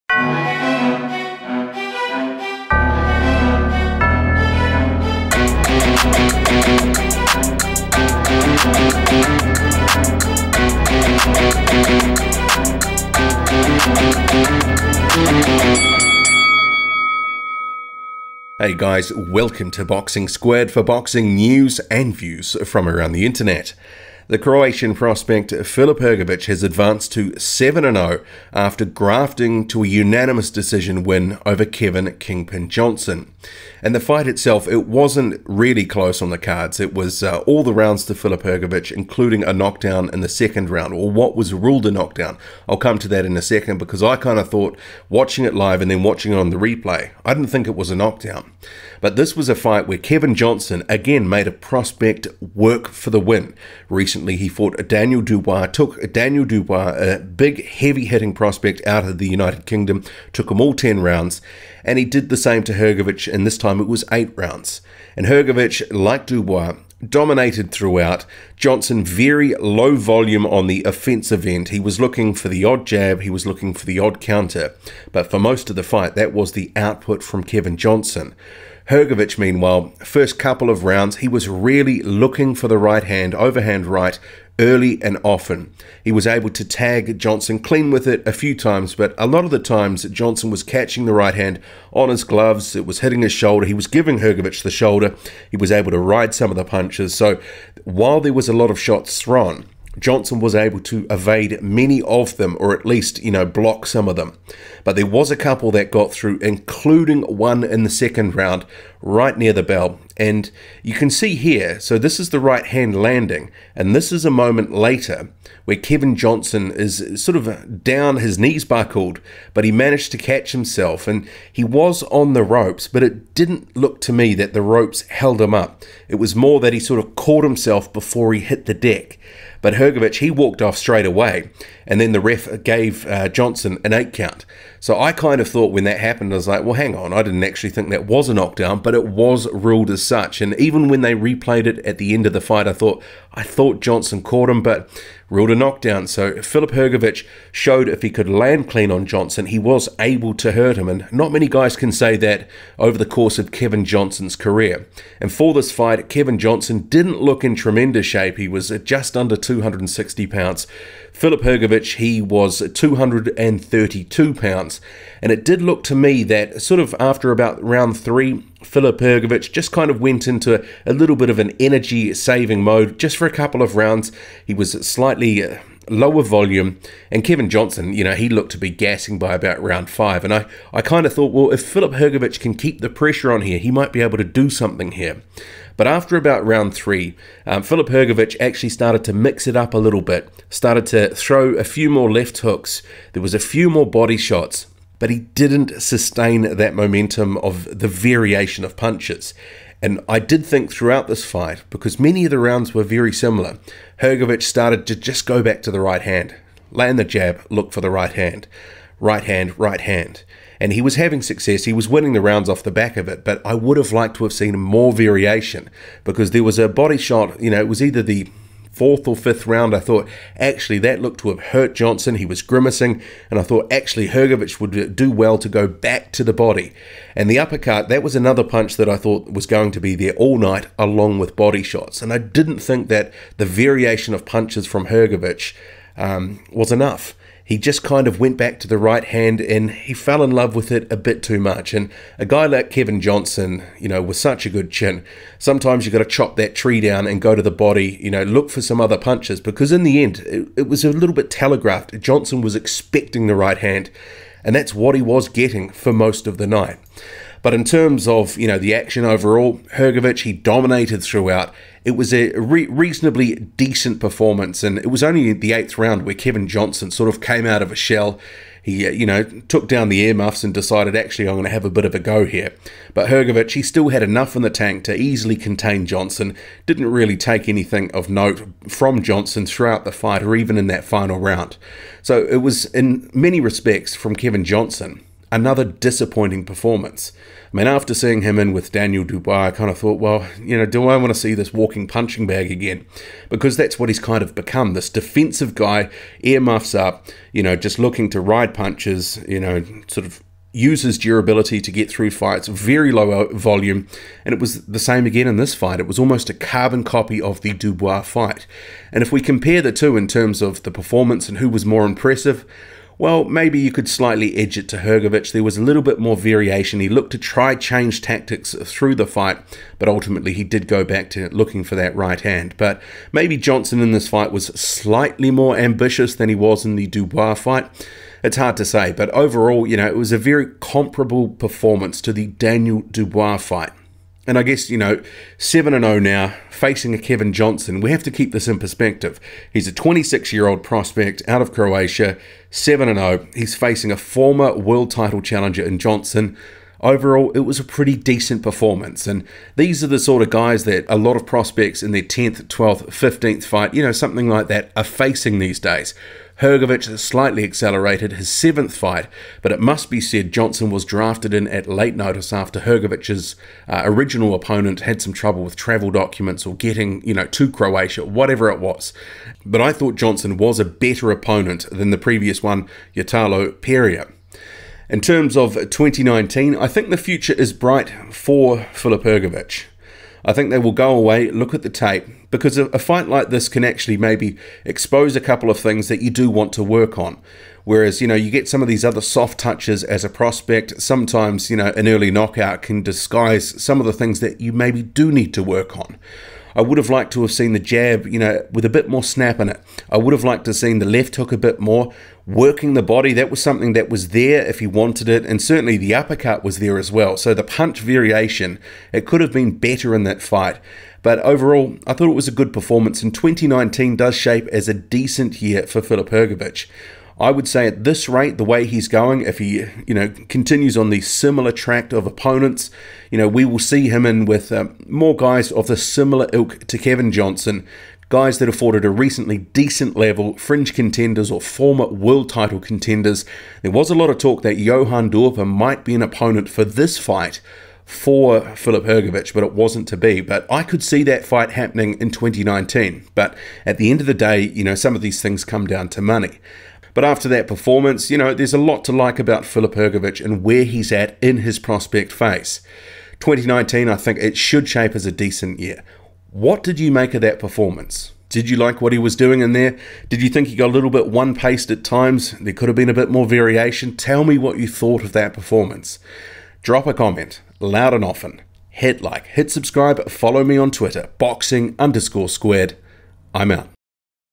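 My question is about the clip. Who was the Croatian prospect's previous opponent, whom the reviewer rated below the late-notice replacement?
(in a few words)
Ytalo Perea.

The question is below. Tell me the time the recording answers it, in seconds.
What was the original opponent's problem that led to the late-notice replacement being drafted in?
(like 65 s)
365 s.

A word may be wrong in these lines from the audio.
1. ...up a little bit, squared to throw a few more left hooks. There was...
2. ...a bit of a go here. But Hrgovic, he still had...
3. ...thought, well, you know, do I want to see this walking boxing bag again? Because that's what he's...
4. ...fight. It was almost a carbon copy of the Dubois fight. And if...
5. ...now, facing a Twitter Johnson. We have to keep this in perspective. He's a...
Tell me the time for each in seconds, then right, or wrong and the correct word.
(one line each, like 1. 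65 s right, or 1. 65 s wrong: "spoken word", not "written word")
1. 189 s wrong: "started", not "squared"
2. 271 s right
3. 289 s wrong: "punching", not "boxing"
4. 305 s right
5. 335 s wrong: "Kevin", not "Twitter".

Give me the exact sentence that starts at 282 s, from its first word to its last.
So it was, in many respects, from Kevin Johnson another disappointing performance.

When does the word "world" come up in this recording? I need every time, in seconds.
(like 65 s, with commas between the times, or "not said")
344 s, 431 s.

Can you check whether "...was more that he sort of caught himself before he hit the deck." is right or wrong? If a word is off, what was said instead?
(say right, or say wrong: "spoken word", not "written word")
right.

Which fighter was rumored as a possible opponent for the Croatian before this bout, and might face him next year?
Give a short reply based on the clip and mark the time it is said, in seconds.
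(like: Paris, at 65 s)
Johann Duhaupas, at 434 s.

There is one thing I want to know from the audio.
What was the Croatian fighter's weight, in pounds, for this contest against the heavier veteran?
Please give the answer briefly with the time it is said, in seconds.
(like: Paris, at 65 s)
232, at 162 s.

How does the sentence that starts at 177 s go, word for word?
And Kevin Johnson, you know, he looked to be gassing by about round five.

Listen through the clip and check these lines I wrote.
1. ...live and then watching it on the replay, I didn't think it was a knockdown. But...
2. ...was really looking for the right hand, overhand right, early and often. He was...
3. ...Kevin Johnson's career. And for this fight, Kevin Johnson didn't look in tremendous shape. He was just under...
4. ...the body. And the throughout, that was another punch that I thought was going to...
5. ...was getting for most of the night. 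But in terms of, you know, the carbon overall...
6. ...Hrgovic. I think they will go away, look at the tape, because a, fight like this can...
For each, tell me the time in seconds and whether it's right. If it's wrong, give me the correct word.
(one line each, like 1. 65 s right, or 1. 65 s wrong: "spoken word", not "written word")
1. 45 s right
2. 81 s right
3. 153 s right
4. 226 s wrong: "uppercut", not "throughout"
5. 255 s wrong: "action", not "carbon"
6. 379 s right.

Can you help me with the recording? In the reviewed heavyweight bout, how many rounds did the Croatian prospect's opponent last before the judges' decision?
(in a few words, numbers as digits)
8.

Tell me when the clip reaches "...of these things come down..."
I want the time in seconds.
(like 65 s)
444 s.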